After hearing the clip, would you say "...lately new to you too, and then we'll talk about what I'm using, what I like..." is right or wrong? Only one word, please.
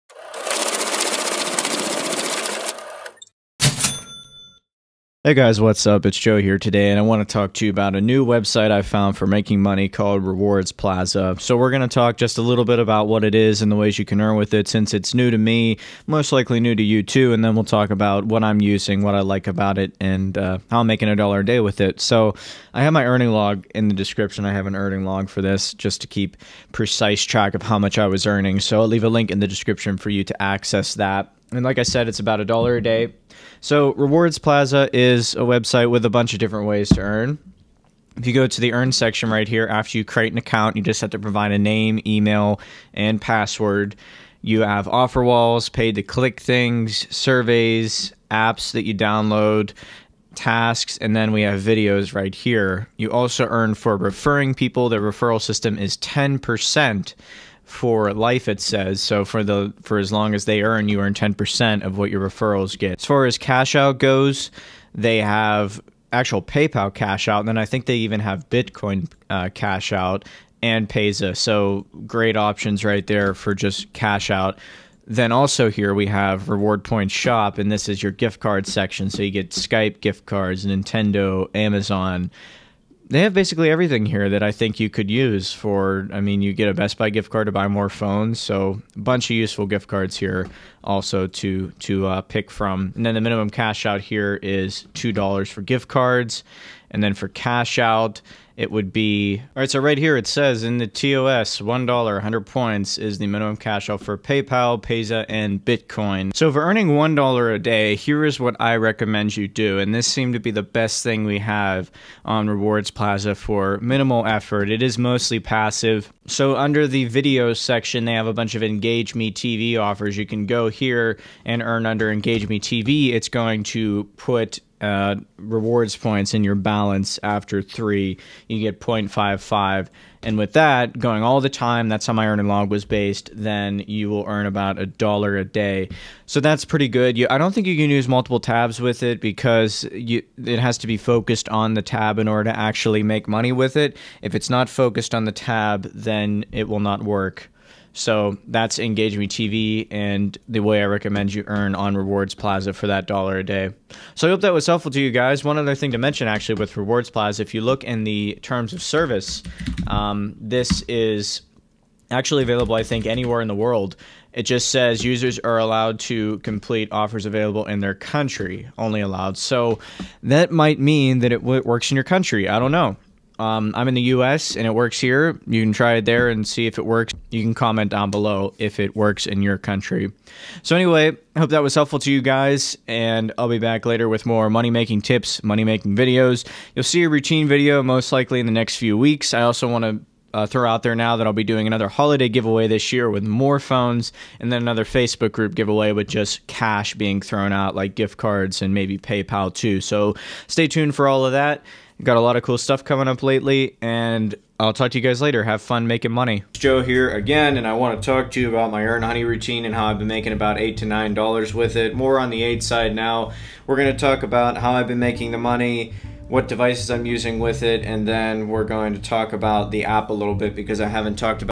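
wrong.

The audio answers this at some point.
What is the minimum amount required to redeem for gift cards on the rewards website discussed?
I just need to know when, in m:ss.
1:34.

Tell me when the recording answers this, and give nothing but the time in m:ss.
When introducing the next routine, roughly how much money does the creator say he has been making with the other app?
3:30.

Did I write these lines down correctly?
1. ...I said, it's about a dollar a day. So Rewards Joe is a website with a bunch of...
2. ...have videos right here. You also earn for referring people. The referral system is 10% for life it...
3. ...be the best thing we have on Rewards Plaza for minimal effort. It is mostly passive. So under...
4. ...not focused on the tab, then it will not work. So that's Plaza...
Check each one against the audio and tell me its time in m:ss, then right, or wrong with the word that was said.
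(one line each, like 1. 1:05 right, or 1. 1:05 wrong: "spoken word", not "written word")
1. 0:31 wrong: "Plaza", not "Joe"
2. 0:51 right
3. 1:50 right
4. 2:24 wrong: "Engage", not "Plaza".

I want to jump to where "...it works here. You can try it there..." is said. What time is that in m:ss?
2:54.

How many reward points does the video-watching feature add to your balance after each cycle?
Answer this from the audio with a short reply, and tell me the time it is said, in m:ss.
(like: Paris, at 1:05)
0.55, at 2:08.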